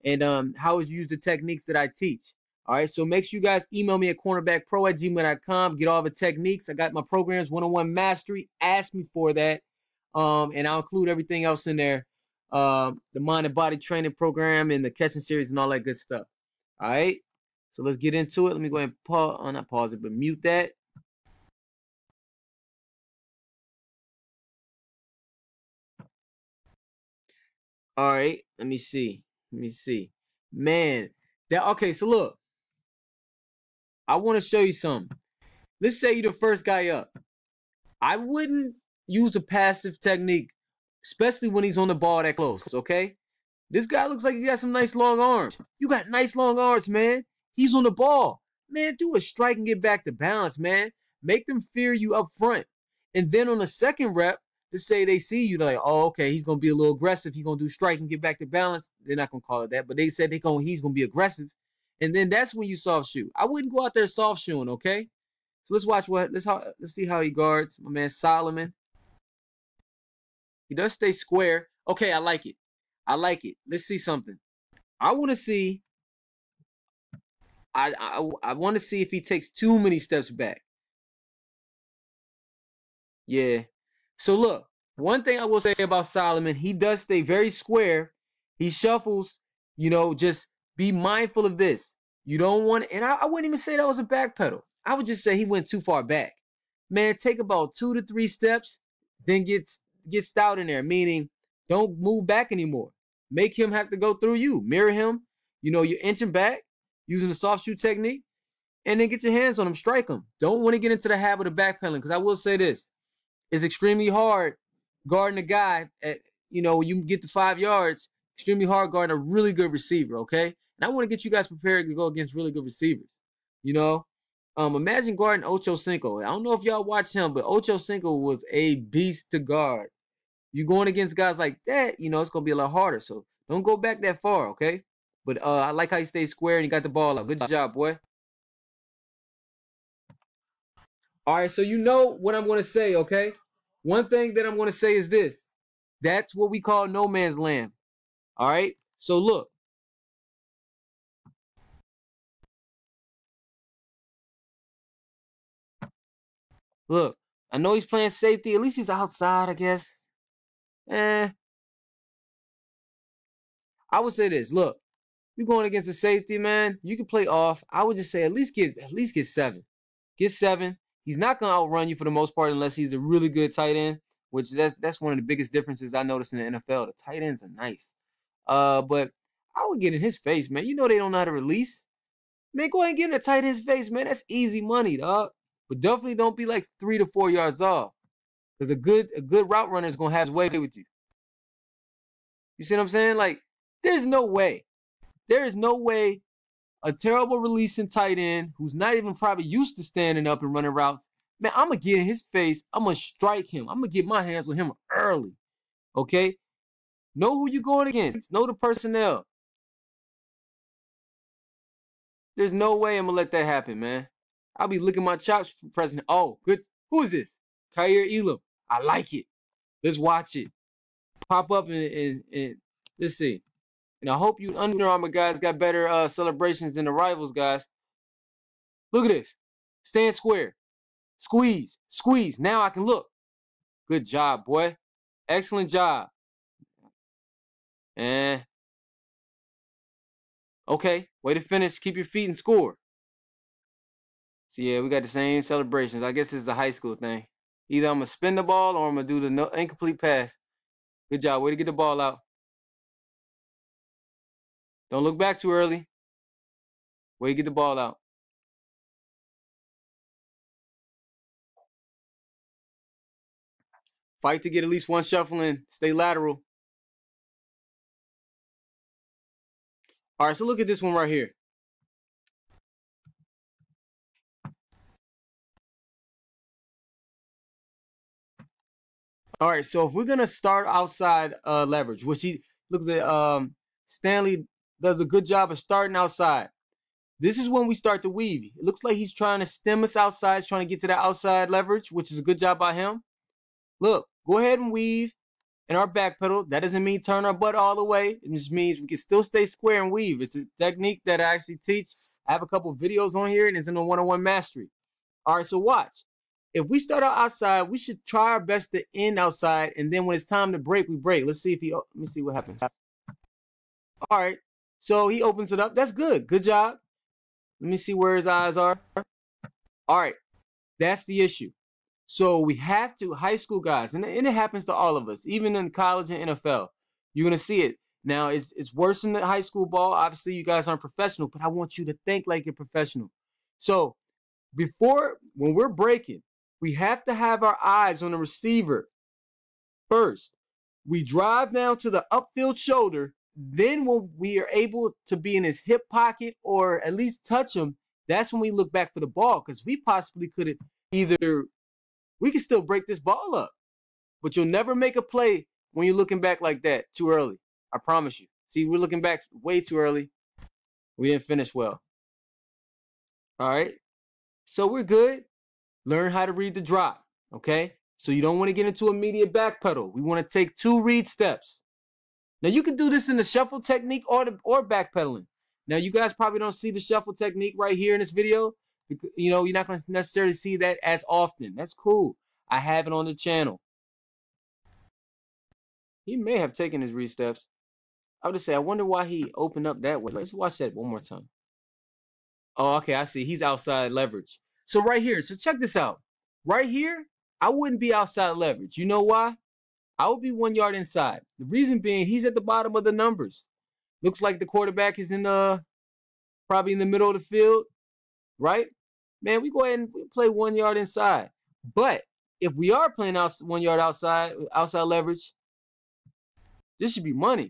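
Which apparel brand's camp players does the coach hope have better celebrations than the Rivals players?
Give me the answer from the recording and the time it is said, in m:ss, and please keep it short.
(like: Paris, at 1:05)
Under Armour, at 3:44.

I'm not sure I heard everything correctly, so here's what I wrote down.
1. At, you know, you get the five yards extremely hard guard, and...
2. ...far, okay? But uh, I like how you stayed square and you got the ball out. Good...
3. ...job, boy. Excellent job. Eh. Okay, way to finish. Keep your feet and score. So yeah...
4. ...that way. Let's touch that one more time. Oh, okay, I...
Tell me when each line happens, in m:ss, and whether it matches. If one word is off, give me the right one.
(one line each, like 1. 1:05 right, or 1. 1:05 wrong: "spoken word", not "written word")
1. 1:56 right
2. 2:14 right
3. 3:54 right
4. 6:29 wrong: "watch", not "touch".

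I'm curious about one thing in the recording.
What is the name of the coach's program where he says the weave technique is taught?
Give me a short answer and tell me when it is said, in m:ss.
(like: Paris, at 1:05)
One-on-one mastery, at 5:03.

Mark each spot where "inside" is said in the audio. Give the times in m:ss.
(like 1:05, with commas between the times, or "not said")
6:40, 6:50.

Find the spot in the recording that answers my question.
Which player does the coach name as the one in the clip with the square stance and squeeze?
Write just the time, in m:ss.
3:37.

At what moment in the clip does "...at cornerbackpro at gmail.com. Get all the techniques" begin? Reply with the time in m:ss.
0:04.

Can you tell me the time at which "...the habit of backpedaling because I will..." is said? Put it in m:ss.
1:51.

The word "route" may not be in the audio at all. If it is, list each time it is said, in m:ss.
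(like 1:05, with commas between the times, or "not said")
3:09, 3:20.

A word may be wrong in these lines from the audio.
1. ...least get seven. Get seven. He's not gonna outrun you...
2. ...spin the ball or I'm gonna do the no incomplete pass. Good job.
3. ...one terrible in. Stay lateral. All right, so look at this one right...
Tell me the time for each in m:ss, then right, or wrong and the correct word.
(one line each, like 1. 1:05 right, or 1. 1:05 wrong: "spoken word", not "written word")
1. 2:48 right
2. 4:08 right
3. 4:24 wrong: "shuffle", not "terrible".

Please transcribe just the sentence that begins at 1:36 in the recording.
Man, take about two to three steps, then get get stout in there, meaning don't move back anymore.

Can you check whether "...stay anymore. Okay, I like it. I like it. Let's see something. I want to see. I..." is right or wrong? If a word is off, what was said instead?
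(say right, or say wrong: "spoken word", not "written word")
wrong: "square", not "anymore".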